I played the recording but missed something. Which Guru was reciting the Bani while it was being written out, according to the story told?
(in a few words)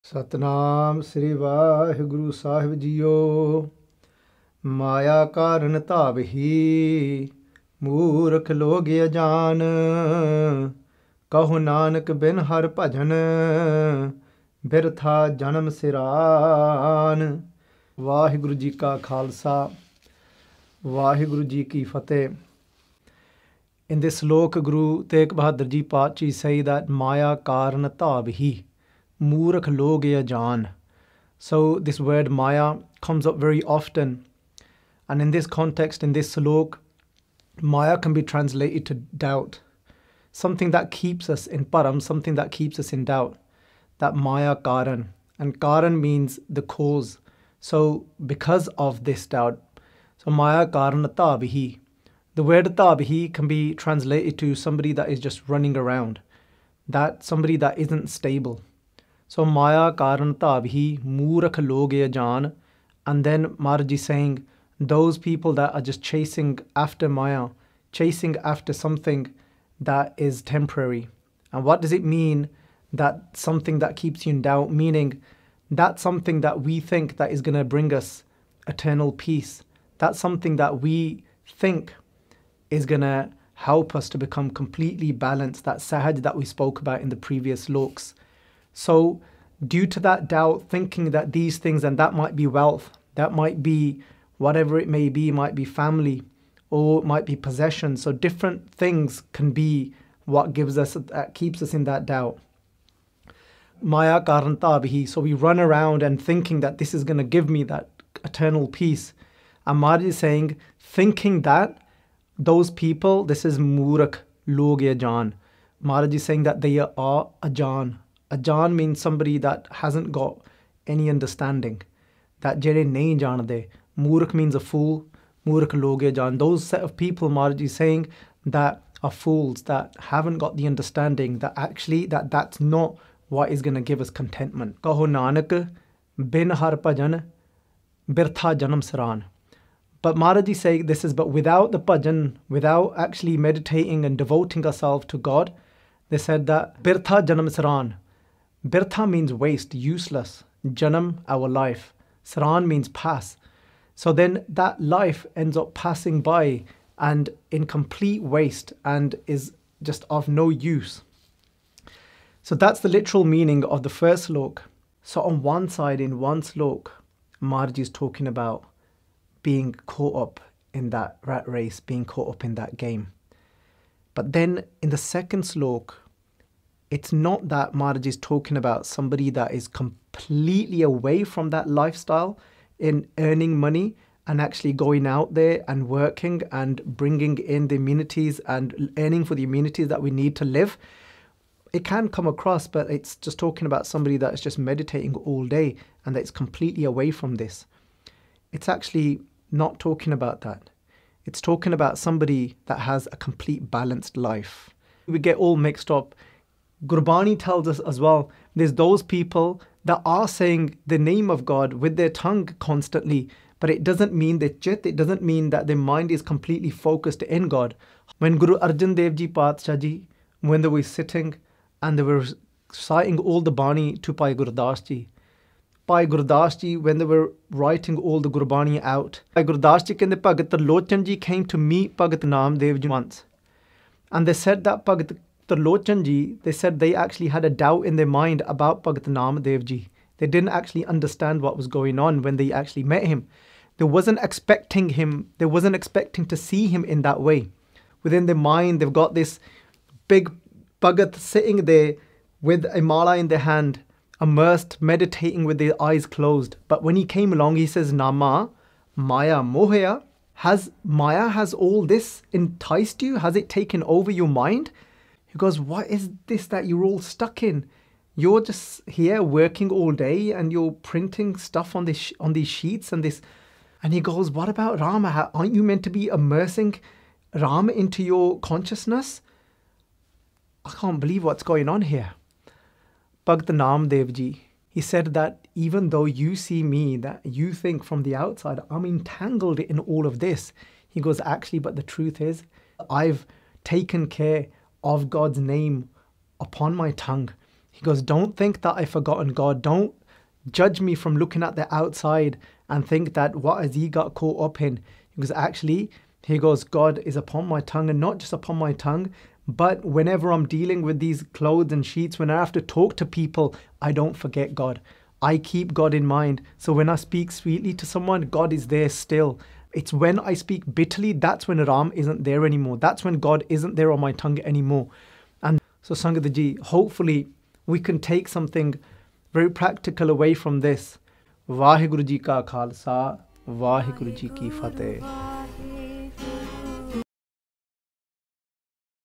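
Guru Arjan Dev Ji.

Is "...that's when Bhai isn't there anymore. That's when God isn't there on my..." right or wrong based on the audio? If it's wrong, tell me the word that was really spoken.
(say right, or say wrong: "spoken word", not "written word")
wrong: "Ram", not "Bhai".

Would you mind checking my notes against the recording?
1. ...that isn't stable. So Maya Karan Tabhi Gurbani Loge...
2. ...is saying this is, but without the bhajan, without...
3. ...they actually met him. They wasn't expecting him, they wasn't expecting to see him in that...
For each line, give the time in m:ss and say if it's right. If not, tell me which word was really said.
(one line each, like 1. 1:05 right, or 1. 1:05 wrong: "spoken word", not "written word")
1. 0:57 wrong: "Murakh", not "Gurbani"
2. 2:20 right
3. 4:02 right.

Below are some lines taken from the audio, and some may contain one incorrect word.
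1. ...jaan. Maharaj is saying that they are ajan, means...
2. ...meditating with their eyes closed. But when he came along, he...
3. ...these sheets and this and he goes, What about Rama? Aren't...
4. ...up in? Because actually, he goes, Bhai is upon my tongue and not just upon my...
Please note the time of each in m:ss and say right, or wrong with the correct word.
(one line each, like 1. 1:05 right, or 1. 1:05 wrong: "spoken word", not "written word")
1. 1:54 right
2. 4:14 right
3. 4:32 right
4. 5:04 wrong: "God", not "Bhai".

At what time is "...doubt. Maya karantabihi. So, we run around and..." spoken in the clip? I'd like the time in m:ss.
1:42.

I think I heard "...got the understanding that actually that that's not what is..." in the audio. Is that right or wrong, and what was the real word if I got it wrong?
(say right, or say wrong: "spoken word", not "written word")
right.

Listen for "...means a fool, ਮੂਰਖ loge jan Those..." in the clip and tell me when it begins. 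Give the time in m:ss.
2:04.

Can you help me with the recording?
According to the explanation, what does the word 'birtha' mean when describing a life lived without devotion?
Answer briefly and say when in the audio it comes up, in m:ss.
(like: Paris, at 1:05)
waste, useless, at 2:28.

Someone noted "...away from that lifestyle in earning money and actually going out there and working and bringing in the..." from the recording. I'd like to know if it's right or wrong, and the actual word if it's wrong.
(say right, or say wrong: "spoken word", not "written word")
right.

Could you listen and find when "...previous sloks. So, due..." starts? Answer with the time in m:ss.
1:27.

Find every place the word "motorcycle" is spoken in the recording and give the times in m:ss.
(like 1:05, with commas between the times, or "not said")
not said.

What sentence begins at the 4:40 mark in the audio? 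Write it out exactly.
I can't believe what's going on here.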